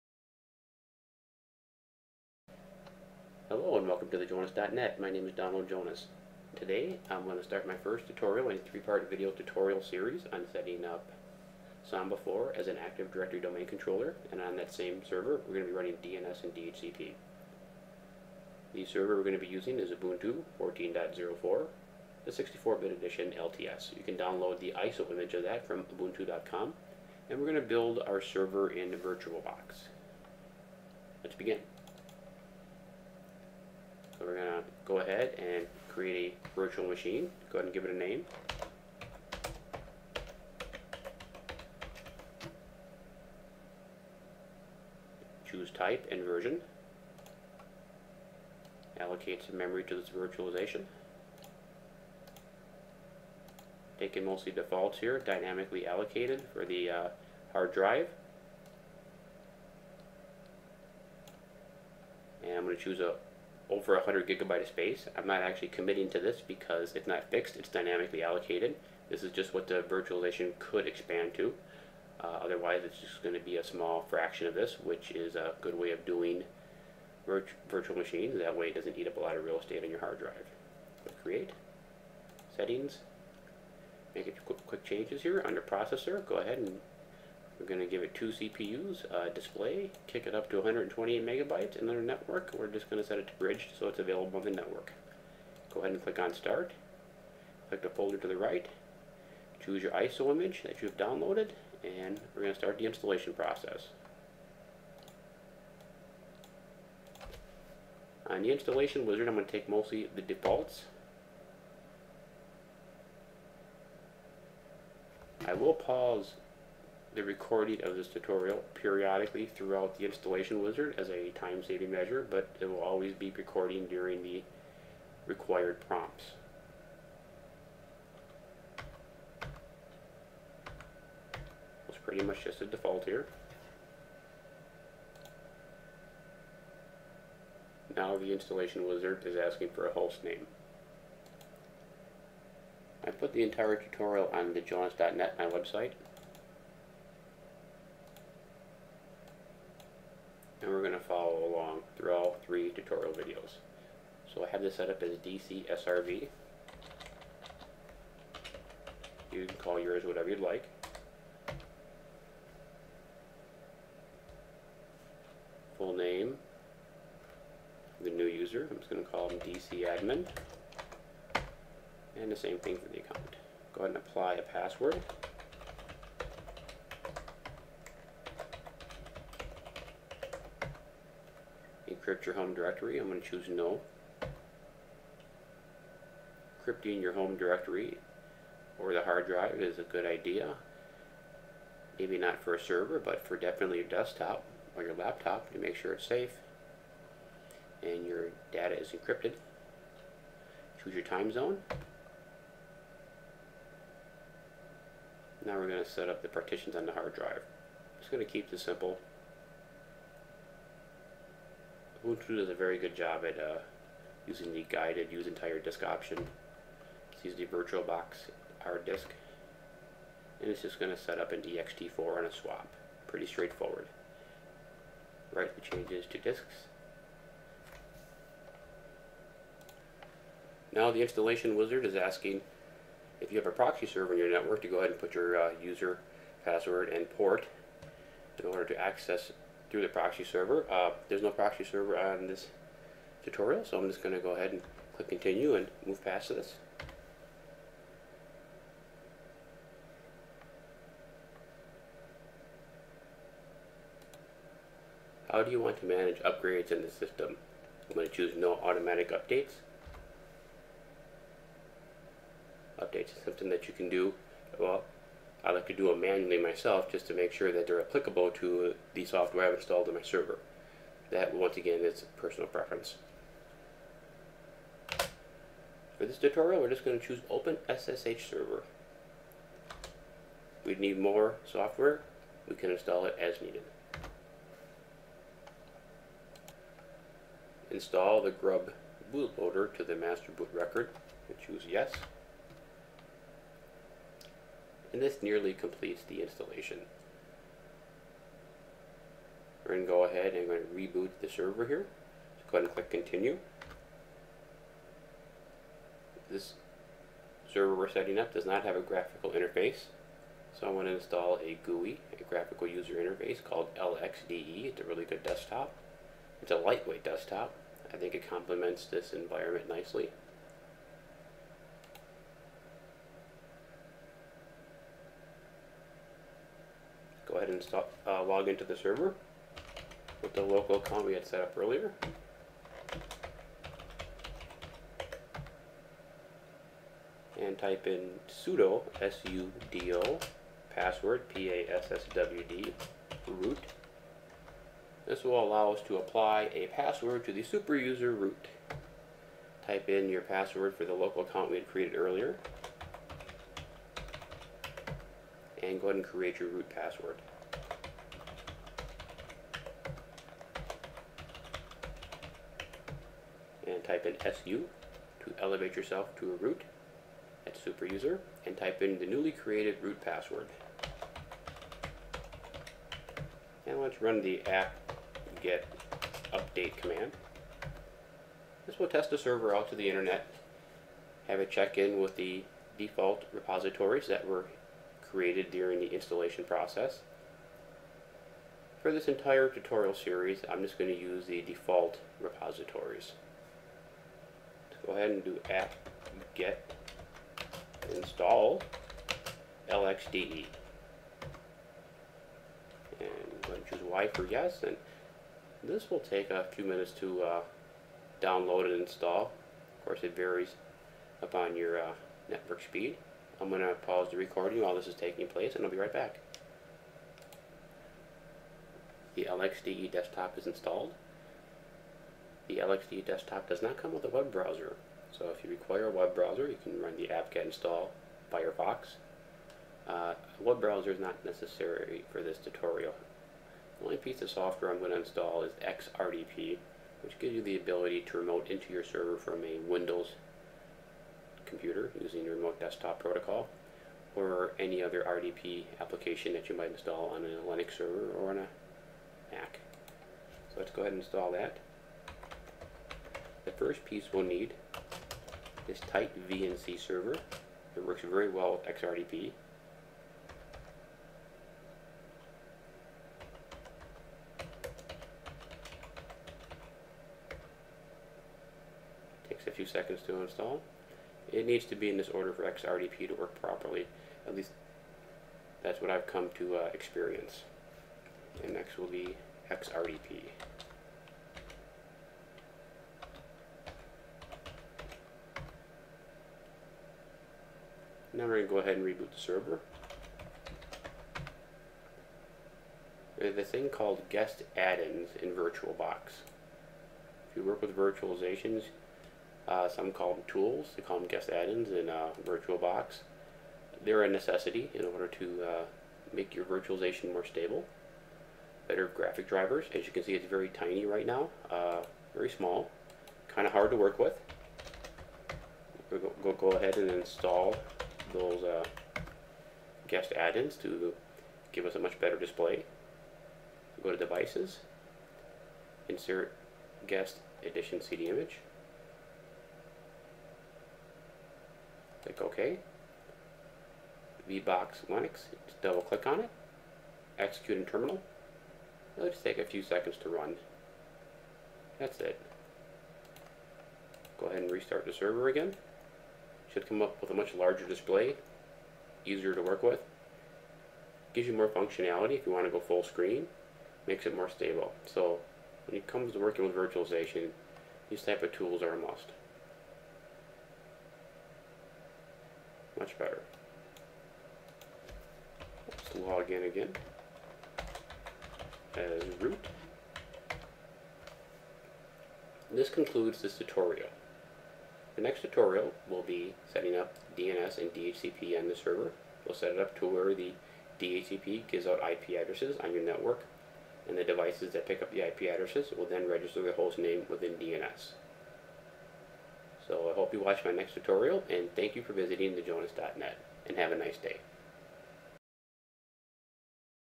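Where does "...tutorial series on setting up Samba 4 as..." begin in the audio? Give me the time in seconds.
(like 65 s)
9 s.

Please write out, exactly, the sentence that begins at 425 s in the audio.
So if you require a web browser, you can run the apt-get install Firefox.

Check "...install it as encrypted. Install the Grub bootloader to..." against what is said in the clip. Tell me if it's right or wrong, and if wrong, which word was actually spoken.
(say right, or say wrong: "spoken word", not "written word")
wrong: "needed", not "encrypted".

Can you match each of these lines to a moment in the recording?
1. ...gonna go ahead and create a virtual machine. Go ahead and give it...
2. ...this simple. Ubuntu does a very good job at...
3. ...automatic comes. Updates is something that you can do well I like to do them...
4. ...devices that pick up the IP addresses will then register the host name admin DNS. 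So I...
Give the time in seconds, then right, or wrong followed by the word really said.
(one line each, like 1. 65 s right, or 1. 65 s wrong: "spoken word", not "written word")
1. 34 s right
2. 208 s right
3. 258 s wrong: "updates", not "comes"
4. 584 s wrong: "within", not "admin".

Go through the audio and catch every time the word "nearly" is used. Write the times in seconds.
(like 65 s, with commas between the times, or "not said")
295 s.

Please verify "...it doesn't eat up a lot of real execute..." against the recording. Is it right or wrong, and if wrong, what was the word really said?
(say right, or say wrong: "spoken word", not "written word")
wrong: "estate", not "execute".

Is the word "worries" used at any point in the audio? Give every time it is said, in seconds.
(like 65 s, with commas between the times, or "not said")
not said.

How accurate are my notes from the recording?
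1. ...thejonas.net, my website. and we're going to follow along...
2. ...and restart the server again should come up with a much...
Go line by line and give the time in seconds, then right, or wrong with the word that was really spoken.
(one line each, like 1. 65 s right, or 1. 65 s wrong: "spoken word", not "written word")
1. 144 s right
2. 544 s right.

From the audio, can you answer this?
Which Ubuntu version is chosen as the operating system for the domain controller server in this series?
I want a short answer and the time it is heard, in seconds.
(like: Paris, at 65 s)
Ubuntu 14.04, at 19 s.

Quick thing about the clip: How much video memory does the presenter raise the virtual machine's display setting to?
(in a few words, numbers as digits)
128 megabytes.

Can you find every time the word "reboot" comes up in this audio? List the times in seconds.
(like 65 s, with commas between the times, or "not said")
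300 s, 488 s.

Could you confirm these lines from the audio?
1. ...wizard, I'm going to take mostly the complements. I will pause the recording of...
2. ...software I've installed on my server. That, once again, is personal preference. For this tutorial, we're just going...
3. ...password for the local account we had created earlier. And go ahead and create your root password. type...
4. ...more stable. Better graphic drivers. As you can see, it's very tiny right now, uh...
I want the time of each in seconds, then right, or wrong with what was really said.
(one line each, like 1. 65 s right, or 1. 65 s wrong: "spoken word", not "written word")
1. 109 s wrong: "defaults", not "complements"
2. 269 s right
3. 350 s right
4. 507 s right.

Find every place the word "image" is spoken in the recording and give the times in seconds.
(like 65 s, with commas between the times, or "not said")
25 s, 100 s, 528 s.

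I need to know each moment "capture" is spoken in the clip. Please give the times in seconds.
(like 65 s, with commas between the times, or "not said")
not said.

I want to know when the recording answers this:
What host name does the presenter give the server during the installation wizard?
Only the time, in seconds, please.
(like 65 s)
155 s.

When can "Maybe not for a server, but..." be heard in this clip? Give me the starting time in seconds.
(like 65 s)
191 s.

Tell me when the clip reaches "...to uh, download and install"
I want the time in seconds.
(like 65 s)
406 s.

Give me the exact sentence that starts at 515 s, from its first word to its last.
We'll go, go ahead and install those uh, guest add-ins to give us a much better display.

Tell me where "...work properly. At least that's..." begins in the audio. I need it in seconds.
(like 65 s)
473 s.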